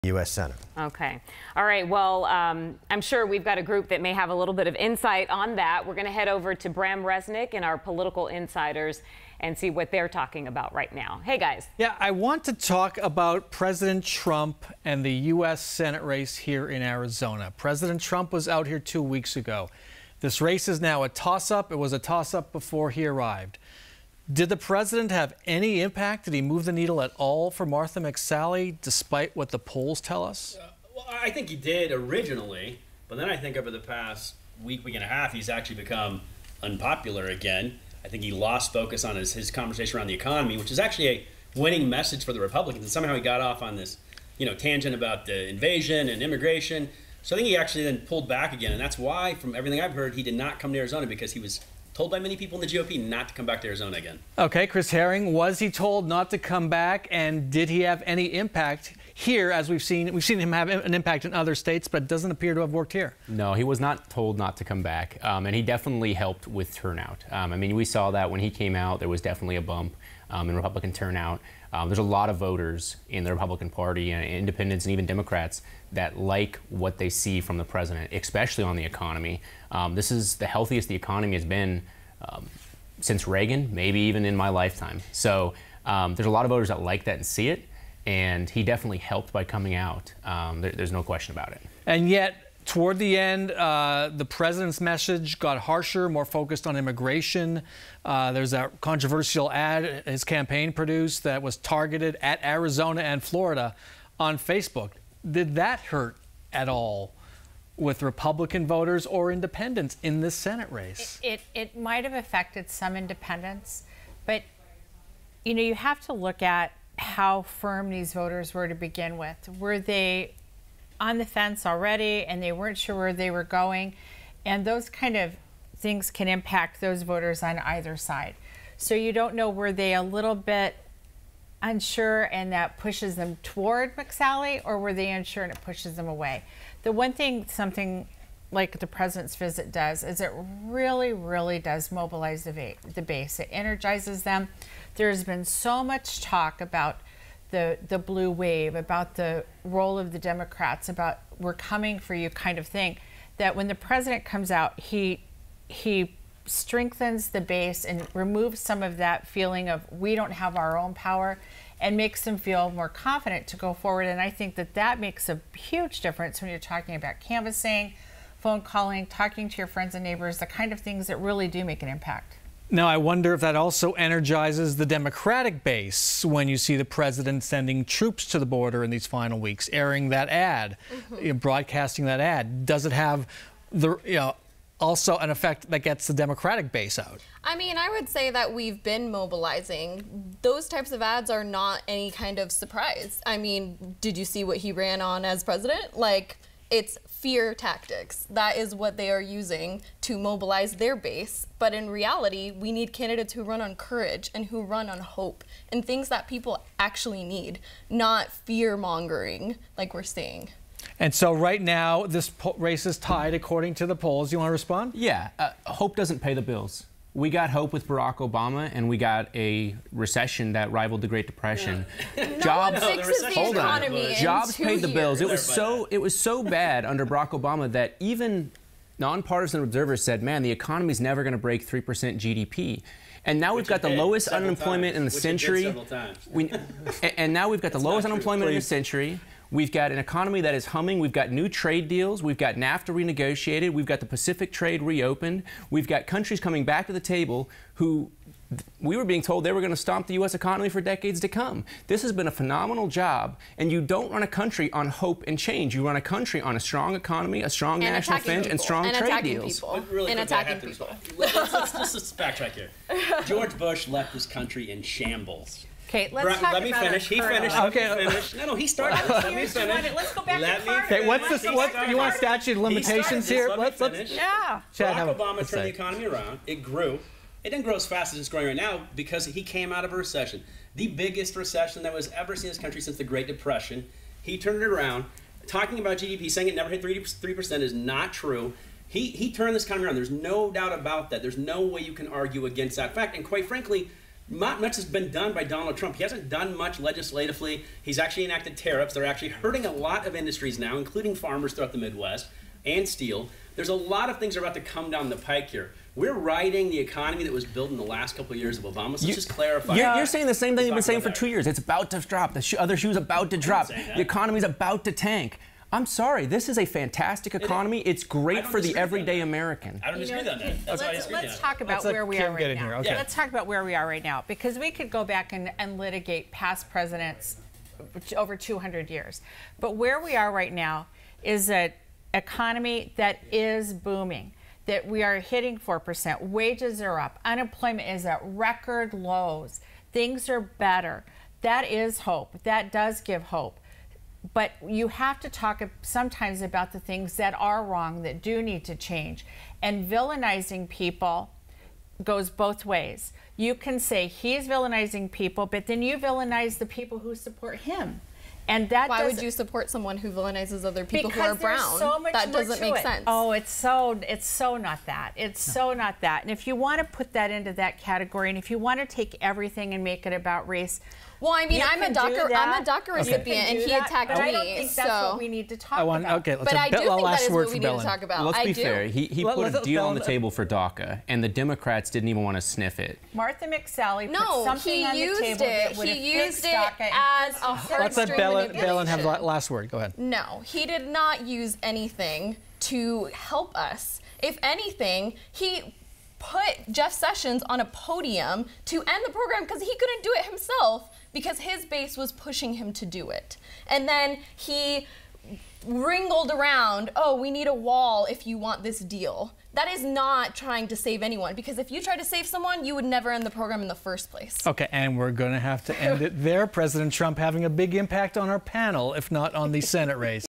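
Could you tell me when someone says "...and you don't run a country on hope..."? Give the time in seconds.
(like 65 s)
253 s.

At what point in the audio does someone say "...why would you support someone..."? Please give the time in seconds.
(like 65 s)
358 s.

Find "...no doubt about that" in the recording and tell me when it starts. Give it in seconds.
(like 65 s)
290 s.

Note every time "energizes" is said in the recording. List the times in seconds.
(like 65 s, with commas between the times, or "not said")
143 s, 173 s.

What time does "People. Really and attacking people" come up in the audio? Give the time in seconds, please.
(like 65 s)
259 s.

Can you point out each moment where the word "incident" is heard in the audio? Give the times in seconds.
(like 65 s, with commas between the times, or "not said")
not said.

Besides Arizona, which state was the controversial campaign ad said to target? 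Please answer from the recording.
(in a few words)
Florida.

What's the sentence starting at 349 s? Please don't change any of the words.
And villainizing people goes both ways.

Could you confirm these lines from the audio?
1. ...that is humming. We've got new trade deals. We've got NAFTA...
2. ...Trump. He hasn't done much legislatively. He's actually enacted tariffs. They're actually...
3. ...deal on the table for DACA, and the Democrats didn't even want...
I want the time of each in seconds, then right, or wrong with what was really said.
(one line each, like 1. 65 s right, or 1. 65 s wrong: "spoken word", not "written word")
1. 240 s right
2. 295 s right
3. 379 s right.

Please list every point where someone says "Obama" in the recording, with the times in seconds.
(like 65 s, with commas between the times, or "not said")
218 s, 227 s, 275 s, 308 s.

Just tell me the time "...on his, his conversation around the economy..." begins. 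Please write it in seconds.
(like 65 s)
39 s.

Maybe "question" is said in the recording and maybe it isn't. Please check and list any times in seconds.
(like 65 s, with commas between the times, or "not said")
91 s.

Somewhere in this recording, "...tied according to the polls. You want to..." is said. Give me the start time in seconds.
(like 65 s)
212 s.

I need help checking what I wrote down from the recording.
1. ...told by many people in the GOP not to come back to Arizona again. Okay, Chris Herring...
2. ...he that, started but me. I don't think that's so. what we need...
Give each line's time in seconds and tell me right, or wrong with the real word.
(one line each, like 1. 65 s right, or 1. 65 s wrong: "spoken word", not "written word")
1. 51 s right
2. 373 s wrong: "attacked", not "started".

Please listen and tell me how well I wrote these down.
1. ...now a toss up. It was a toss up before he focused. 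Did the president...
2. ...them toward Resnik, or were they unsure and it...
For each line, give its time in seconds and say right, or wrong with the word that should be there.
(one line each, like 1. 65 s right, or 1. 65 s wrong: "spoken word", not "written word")
1. 20 s wrong: "arrived", not "focused"
2. 133 s wrong: "McSally", not "Resnik".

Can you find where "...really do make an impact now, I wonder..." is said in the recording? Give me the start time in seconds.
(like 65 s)
171 s.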